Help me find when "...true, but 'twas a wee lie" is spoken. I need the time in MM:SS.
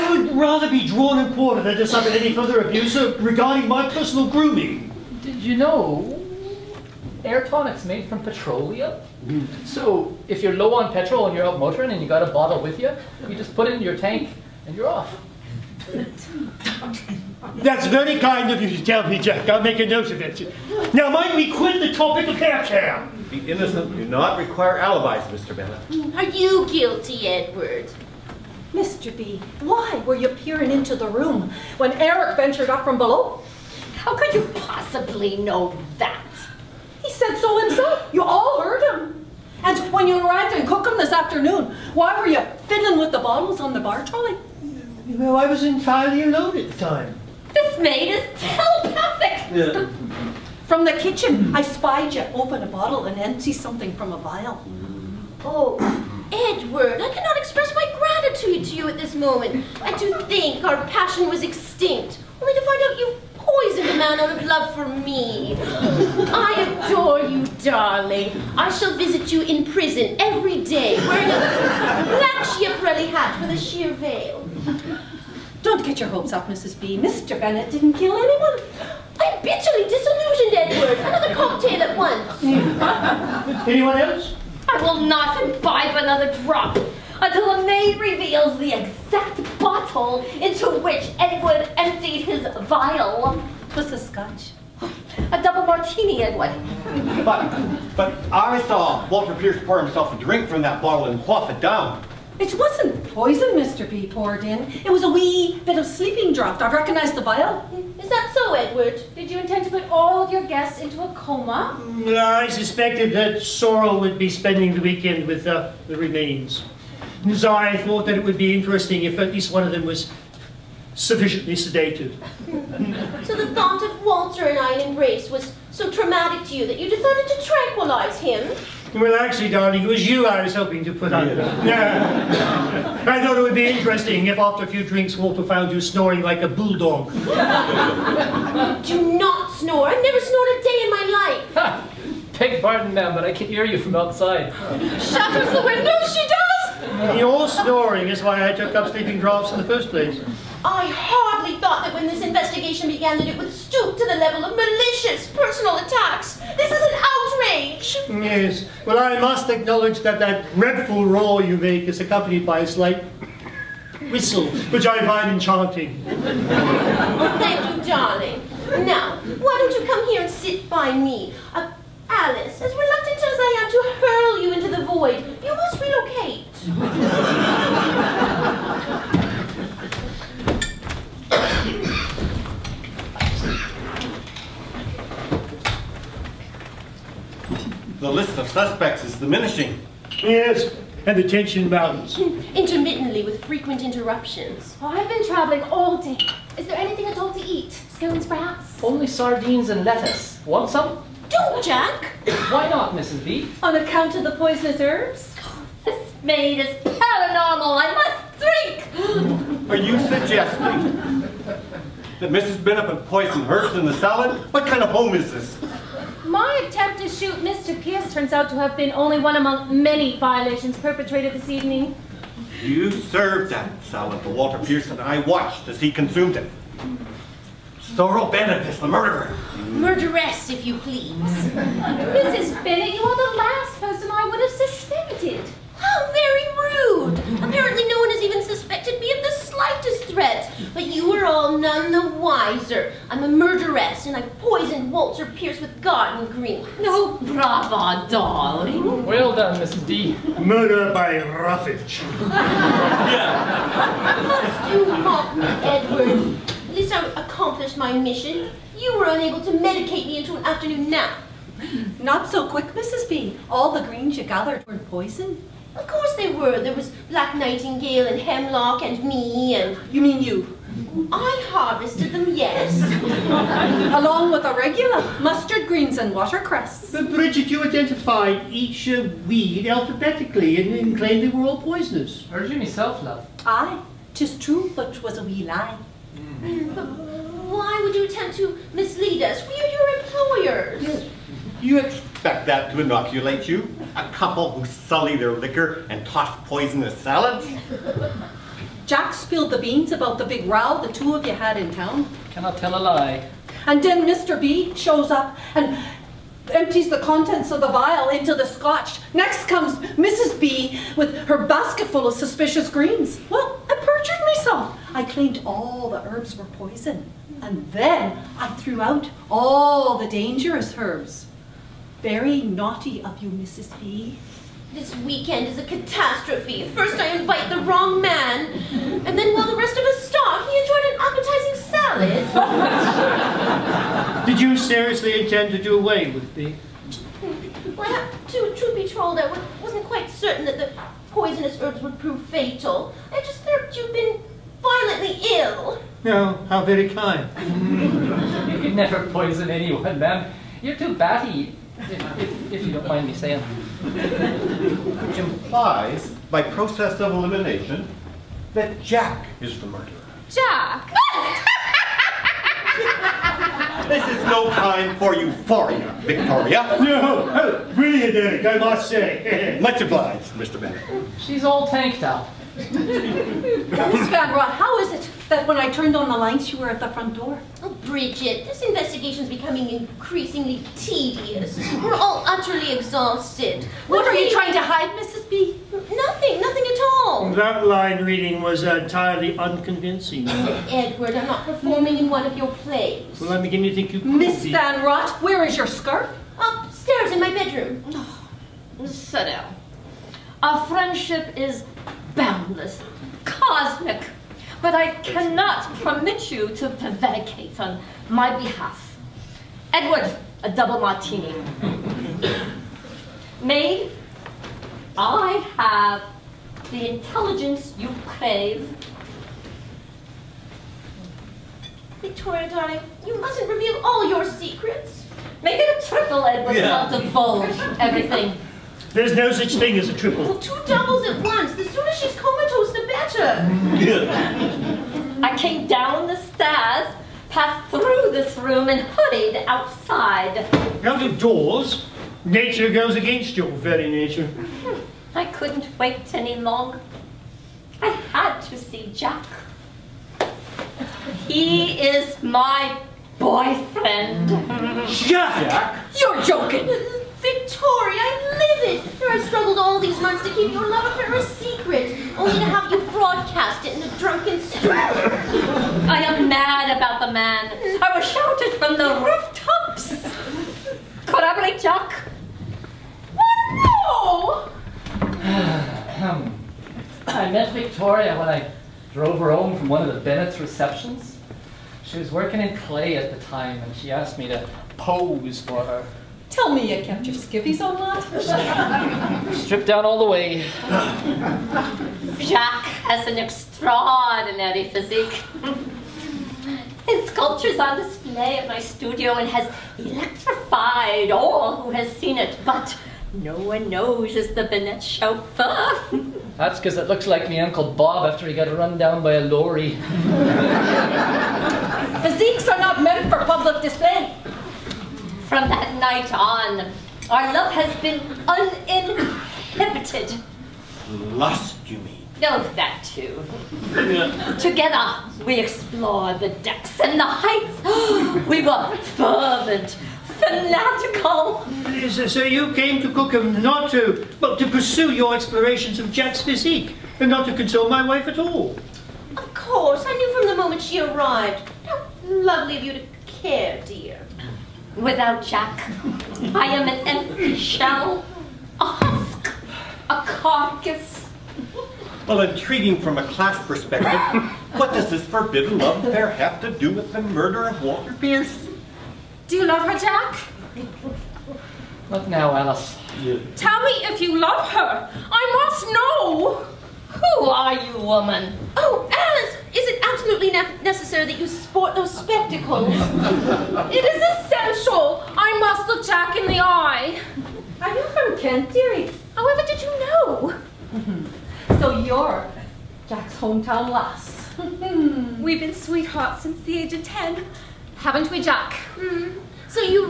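04:44.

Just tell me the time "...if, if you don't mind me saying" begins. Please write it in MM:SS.
05:52.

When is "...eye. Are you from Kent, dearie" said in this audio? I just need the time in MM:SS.
09:36.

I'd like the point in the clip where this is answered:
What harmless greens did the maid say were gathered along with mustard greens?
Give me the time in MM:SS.
04:36.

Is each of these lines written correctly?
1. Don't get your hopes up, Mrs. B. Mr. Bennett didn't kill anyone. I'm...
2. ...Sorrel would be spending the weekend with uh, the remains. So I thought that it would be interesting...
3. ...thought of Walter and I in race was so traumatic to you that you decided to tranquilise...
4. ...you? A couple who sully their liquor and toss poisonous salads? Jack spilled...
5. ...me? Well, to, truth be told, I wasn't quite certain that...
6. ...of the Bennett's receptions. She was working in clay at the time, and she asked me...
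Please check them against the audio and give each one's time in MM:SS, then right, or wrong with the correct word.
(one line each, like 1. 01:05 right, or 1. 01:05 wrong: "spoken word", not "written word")
1. 01:15 right
2. 01:53 right
3. 02:03 right
4. 04:53 right
5. 05:36 right
6. 07:59 right.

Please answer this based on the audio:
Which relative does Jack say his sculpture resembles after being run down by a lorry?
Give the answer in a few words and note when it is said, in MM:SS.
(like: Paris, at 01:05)
Uncle Bob, at 08:27.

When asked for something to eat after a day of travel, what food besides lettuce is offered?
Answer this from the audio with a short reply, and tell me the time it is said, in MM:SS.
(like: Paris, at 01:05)
Sardines, at 03:19.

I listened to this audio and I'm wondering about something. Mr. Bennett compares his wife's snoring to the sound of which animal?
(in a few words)
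A bulldog.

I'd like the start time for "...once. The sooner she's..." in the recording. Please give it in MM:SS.
07:11.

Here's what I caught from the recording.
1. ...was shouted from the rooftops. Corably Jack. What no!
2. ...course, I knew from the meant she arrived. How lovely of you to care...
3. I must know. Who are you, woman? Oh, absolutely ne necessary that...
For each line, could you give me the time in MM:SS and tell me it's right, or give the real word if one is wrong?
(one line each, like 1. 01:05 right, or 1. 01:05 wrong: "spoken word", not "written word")
1. 07:47 right
2. 08:59 wrong: "moment", not "meant"
3. 09:24 right.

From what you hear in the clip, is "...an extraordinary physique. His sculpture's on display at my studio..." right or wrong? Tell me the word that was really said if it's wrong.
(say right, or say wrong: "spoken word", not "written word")
right.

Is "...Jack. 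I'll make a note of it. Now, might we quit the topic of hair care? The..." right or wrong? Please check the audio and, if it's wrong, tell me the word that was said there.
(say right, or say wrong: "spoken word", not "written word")
right.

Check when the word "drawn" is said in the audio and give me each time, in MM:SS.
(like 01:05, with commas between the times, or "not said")
00:00.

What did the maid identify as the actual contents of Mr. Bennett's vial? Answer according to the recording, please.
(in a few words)
Sleeping draught.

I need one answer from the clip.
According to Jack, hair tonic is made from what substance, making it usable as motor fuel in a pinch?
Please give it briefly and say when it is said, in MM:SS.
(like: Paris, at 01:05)
Petroleum, at 00:08.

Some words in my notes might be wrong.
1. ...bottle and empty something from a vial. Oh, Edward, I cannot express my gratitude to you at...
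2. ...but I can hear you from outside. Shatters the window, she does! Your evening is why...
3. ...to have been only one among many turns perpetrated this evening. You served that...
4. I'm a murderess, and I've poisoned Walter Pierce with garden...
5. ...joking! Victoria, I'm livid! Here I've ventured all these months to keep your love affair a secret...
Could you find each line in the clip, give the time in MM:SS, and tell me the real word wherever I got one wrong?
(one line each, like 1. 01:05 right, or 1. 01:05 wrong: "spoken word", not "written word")
1. 00:52 right
2. 02:23 wrong: "snoring", not "evening"
3. 03:38 wrong: "violations", not "turns"
4. 04:03 right
5. 07:36 wrong: "struggled", not "ventured".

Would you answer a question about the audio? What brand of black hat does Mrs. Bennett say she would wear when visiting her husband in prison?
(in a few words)
Schiaparelli.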